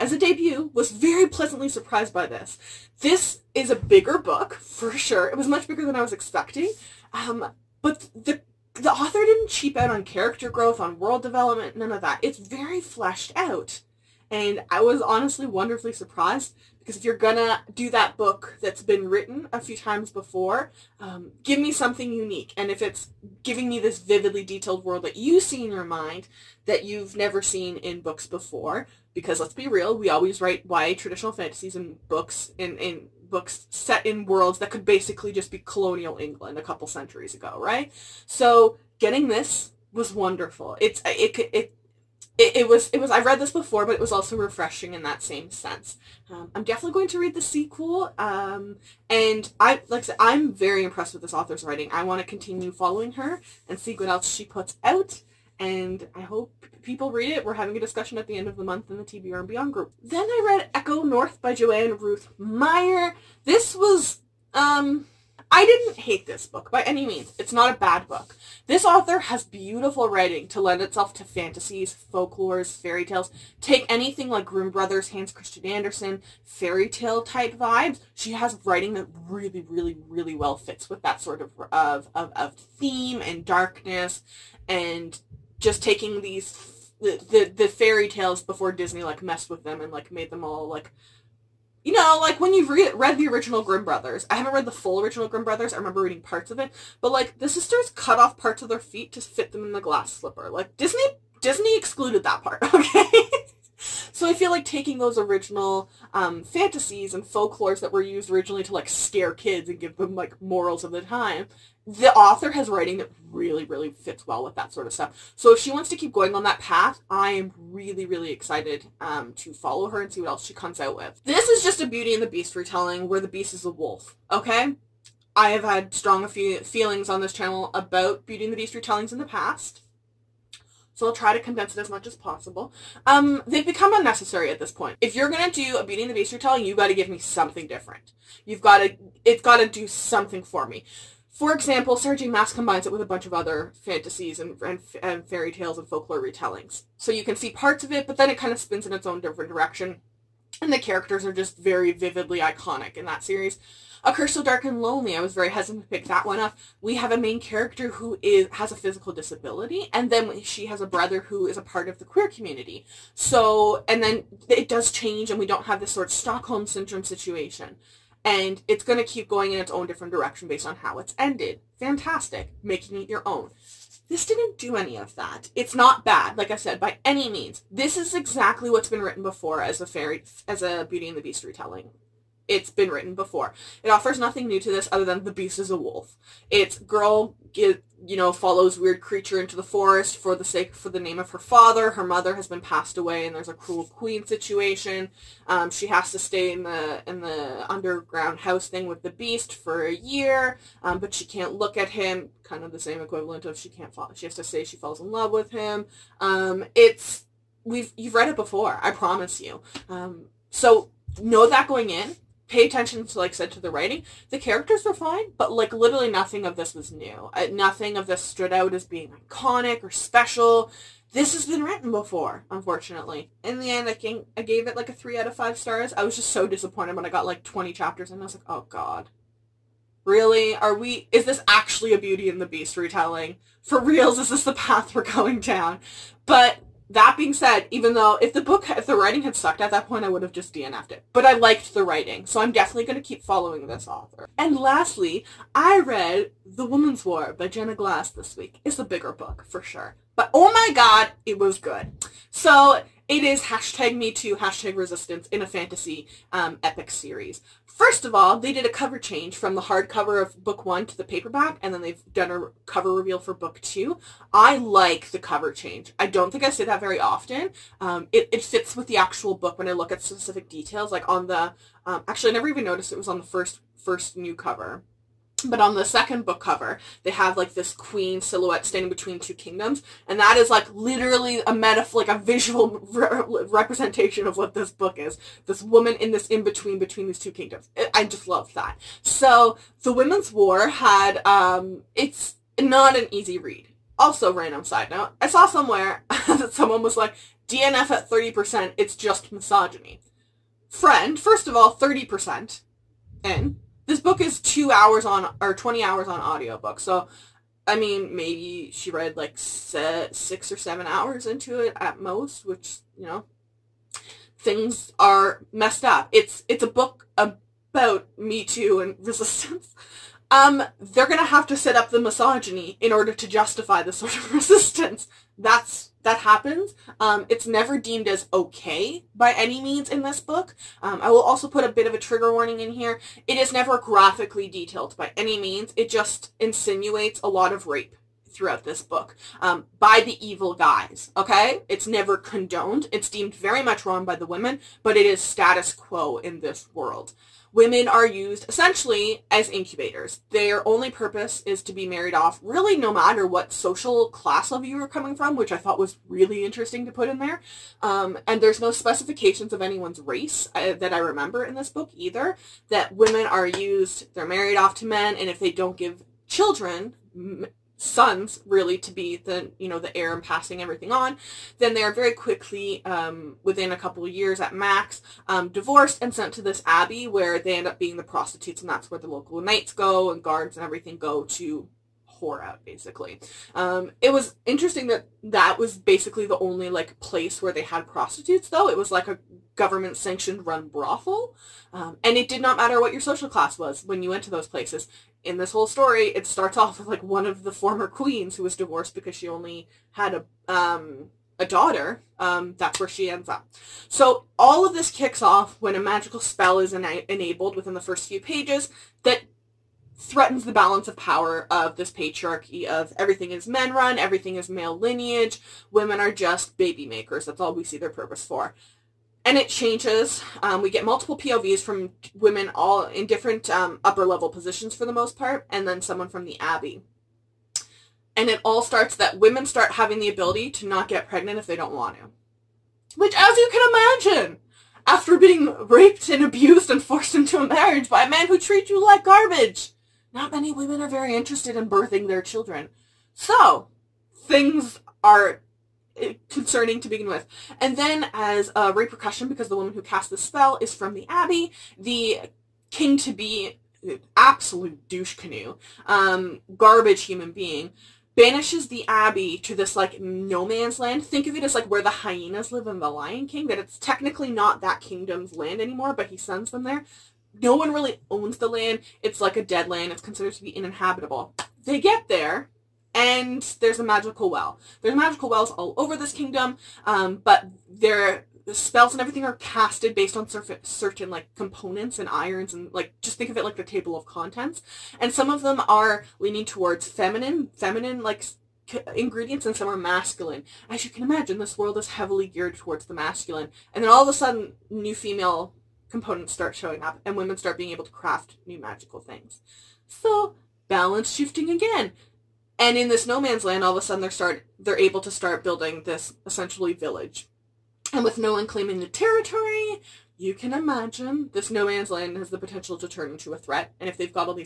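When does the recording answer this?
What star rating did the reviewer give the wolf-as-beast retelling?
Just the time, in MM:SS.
03:44.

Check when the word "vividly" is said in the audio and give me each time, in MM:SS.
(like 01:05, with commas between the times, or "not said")
00:23, 02:31.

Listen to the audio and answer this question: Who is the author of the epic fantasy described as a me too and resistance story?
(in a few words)
Jenna Glass.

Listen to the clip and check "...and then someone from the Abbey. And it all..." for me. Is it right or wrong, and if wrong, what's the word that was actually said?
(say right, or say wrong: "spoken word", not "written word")
right.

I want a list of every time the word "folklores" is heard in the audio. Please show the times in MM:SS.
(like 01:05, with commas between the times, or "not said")
01:12, 01:47, 02:25.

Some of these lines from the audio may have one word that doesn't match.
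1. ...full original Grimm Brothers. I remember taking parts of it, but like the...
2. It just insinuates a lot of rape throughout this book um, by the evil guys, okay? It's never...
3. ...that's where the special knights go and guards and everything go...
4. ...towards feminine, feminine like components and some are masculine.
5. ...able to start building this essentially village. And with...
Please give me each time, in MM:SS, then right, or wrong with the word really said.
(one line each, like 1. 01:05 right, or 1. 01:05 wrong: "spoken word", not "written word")
1. 01:34 wrong: "reading", not "taking"
2. 05:35 right
3. 06:18 wrong: "local", not "special"
4. 08:06 wrong: "ingredients", not "components"
5. 08:24 right.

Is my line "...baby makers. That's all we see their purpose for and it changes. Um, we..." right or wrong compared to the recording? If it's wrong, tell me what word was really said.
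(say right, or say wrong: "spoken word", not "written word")
right.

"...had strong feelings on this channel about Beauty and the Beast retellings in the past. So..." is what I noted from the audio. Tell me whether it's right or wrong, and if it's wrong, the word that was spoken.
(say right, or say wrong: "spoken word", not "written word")
right.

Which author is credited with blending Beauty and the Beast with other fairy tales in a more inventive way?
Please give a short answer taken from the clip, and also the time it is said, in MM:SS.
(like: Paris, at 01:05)
Sarah J. Maas, at 02:21.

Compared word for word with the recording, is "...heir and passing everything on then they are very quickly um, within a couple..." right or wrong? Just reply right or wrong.
right.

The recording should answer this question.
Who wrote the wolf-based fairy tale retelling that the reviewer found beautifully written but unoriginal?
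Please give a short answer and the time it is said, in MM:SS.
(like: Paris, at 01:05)
Joanne Ruth Meyer, at 01:01.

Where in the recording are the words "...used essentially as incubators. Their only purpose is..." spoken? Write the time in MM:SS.
05:48.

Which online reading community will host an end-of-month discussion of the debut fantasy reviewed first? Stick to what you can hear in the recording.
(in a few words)
TBR and Beyond.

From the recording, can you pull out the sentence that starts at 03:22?
Kind of the same equivalent of she can't fall.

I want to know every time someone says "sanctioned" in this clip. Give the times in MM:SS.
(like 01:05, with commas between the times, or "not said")
06:29.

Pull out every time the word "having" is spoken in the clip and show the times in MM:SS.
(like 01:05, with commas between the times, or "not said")
00:57, 07:09.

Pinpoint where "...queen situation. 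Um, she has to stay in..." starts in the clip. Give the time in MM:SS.
03:13.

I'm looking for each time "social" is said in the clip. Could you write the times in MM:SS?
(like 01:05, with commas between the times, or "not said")
05:53, 06:32.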